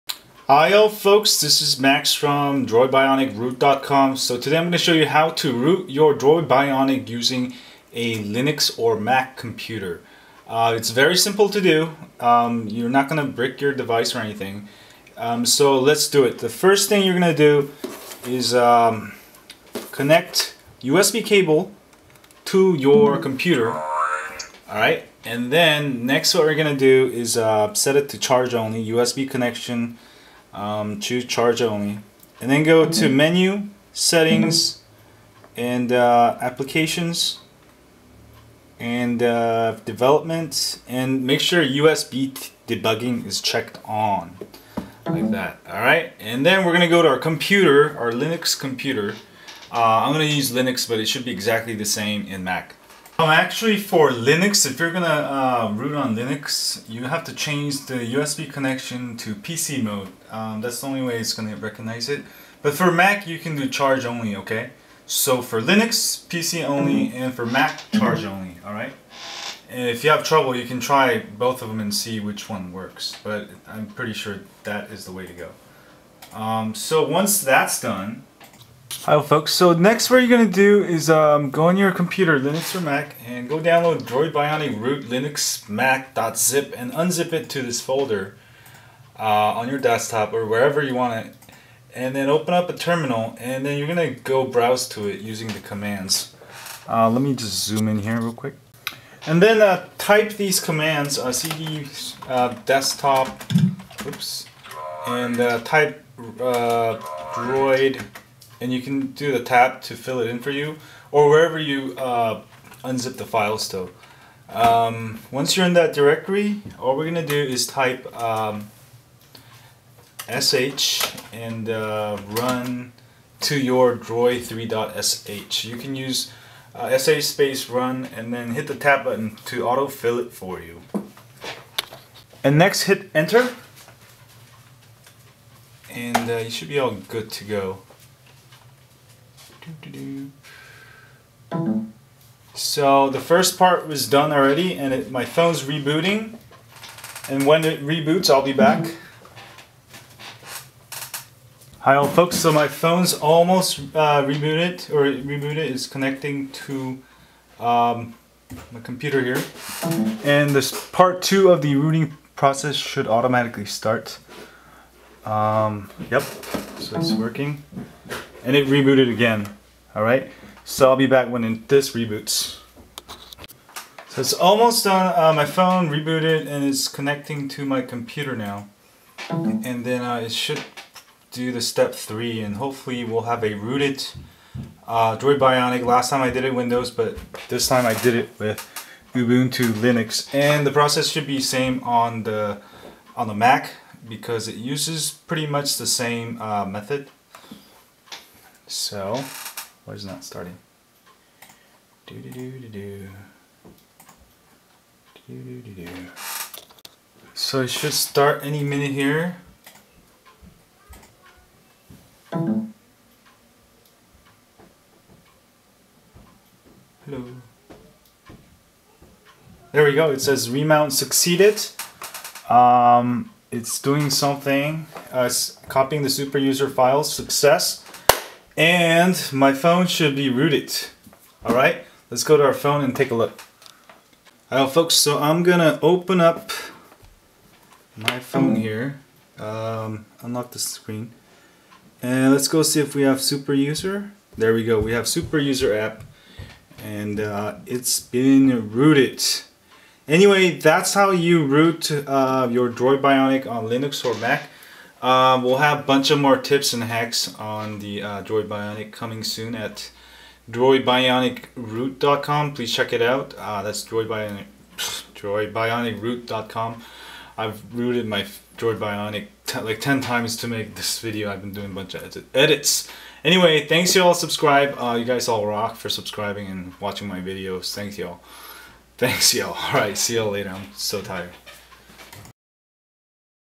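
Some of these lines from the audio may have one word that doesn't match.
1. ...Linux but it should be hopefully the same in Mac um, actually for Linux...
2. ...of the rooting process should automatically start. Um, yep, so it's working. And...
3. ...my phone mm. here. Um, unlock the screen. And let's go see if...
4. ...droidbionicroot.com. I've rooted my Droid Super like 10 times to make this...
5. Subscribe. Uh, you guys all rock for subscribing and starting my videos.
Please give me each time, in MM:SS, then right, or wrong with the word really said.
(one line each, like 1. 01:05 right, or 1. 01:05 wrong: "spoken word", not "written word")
1. 00:50 wrong: "exactly", not "hopefully"
2. 02:41 right
3. 03:57 right
4. 04:24 wrong: "Bionic", not "Super"
5. 04:34 wrong: "watching", not "starting".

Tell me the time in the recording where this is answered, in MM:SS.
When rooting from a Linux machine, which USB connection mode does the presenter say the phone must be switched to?
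00:59.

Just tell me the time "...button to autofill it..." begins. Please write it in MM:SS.
02:09.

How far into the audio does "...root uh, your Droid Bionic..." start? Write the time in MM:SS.
04:11.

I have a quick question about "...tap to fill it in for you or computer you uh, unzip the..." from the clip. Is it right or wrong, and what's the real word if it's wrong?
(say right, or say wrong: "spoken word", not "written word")
wrong: "wherever", not "computer".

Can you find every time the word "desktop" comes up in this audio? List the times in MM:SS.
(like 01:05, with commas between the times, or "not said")
01:29, 01:42.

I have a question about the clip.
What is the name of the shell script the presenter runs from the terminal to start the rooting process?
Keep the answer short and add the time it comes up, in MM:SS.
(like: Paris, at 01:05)
run to your droid3.sh, at 02:02.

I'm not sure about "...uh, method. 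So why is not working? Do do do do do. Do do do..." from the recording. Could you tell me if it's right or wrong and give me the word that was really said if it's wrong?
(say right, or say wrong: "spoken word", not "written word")
wrong: "starting", not "working".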